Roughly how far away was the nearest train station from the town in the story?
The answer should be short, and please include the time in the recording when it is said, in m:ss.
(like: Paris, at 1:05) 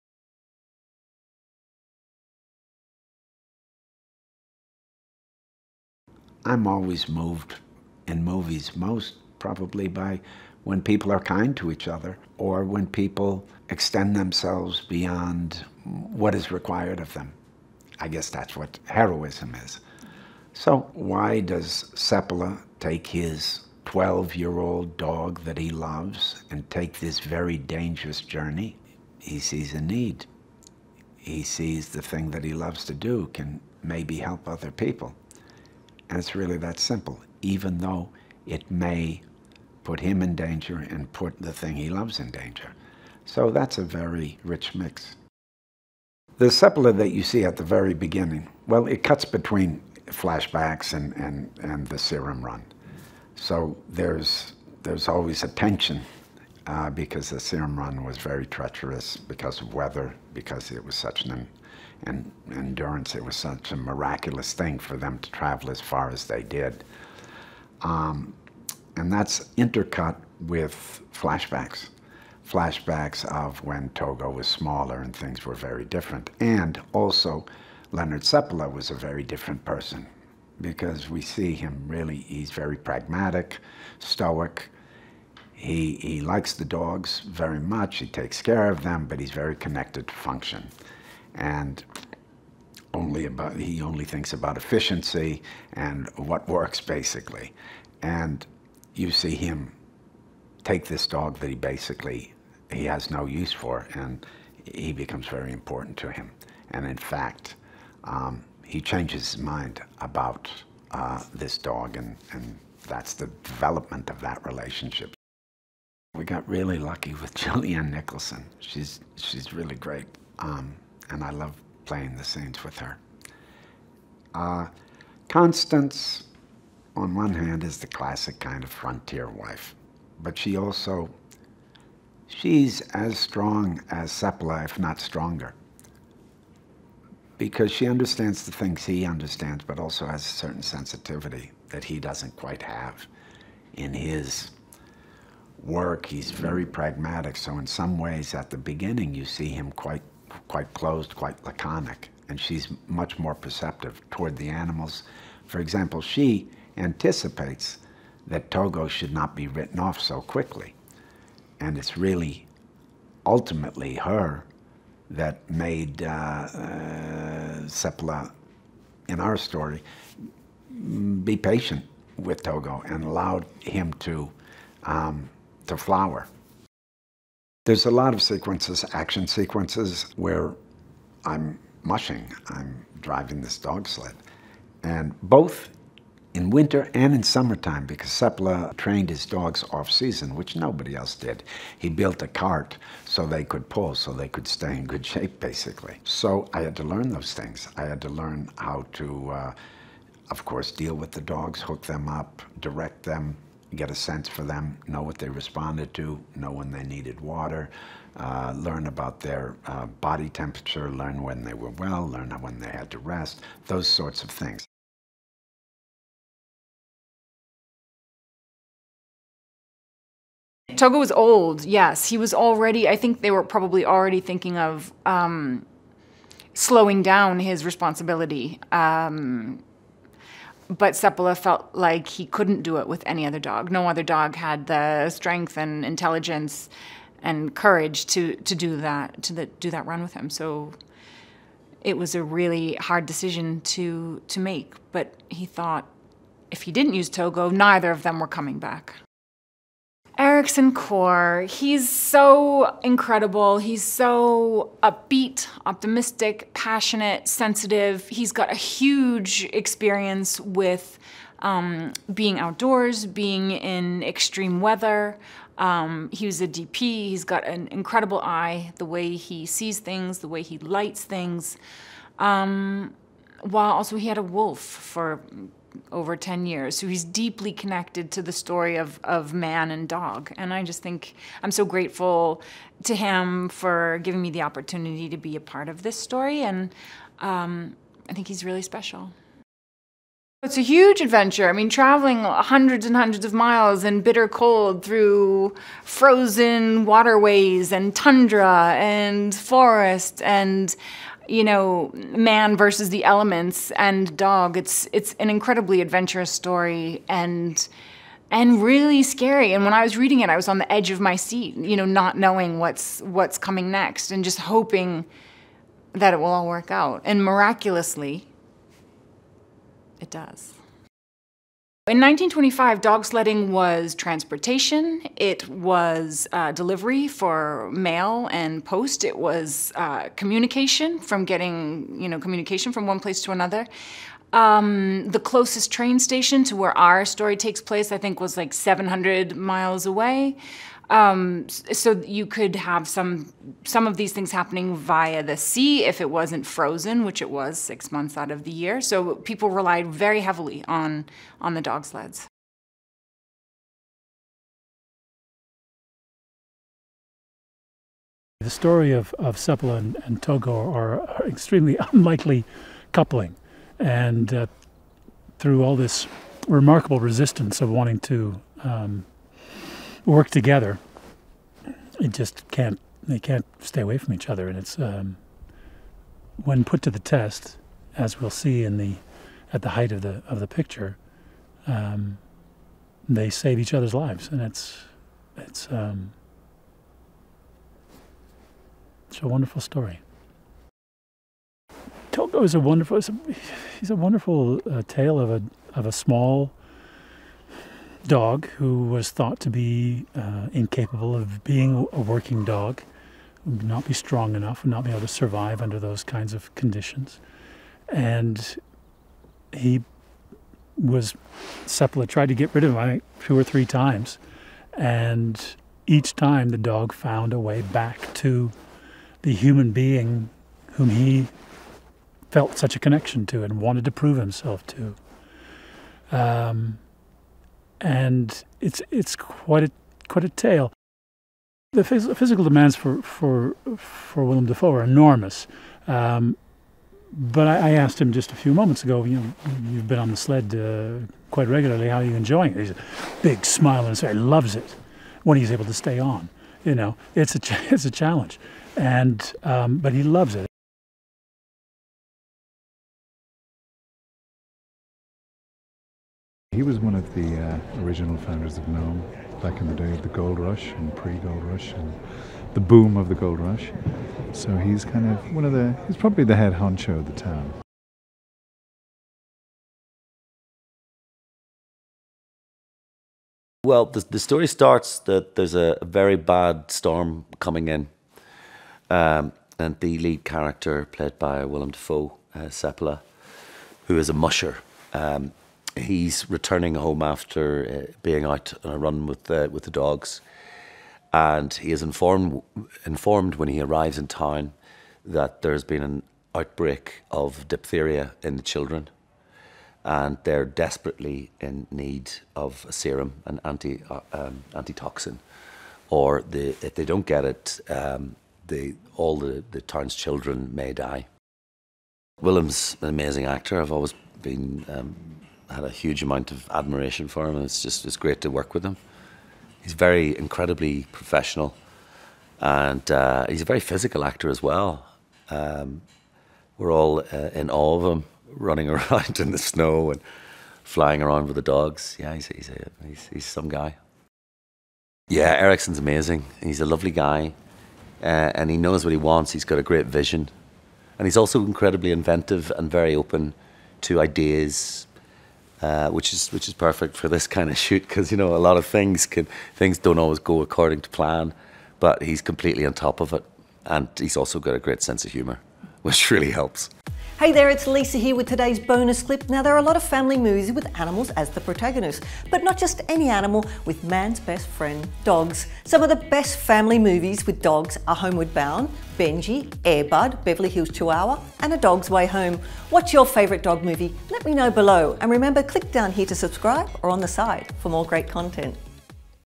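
700 miles, at 5:38.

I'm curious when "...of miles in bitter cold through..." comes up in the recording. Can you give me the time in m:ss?
4:53.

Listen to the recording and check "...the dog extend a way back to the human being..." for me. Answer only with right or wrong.
wrong.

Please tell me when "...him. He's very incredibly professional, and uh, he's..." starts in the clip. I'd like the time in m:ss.
8:38.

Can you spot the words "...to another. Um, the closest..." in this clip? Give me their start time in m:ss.
5:33.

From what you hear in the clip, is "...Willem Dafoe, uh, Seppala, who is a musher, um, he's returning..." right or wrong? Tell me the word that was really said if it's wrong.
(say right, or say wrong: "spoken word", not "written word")
right.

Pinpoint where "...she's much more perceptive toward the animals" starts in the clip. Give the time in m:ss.
2:32.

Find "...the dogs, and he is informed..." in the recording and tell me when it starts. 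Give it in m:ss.
8:09.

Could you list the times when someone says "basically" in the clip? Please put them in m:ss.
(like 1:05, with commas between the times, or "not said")
1:36, 1:41, 3:15.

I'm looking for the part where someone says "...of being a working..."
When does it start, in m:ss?
6:41.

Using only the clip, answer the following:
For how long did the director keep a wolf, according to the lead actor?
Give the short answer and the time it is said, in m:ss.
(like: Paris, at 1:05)
over 10 years, at 4:35.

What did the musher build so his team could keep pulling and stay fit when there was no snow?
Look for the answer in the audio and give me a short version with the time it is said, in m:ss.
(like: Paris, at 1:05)
a cart, at 3:12.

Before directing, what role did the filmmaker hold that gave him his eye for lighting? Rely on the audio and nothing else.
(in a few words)
DP.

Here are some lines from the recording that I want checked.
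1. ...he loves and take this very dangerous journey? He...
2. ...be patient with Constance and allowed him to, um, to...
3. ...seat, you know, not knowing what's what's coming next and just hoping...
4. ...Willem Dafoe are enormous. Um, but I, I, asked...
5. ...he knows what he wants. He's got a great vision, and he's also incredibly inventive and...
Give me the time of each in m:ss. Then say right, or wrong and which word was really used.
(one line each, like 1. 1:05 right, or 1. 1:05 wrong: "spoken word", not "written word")
1. 0:25 right
2. 2:51 wrong: "Togo", not "Constance"
3. 5:11 right
4. 7:14 right
5. 8:58 right.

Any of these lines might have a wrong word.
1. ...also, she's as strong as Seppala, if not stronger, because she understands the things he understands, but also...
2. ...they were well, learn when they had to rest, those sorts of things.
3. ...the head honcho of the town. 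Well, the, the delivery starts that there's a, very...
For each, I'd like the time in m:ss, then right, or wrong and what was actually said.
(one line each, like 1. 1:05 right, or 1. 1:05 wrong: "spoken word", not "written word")
1. 2:10 right
2. 3:31 right
3. 7:46 wrong: "story", not "delivery".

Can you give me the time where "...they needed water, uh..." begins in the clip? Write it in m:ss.
3:26.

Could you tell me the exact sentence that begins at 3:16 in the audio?
So I had to learn those things.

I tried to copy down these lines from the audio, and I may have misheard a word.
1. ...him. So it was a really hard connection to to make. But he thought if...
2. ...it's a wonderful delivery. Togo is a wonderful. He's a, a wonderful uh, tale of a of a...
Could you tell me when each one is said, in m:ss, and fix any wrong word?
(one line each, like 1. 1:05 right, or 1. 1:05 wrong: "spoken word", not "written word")
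1. 4:00 wrong: "decision", not "connection"
2. 6:29 wrong: "story", not "delivery".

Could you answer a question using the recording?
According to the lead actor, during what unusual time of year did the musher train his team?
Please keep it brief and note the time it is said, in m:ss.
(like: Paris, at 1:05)
off season, at 3:09.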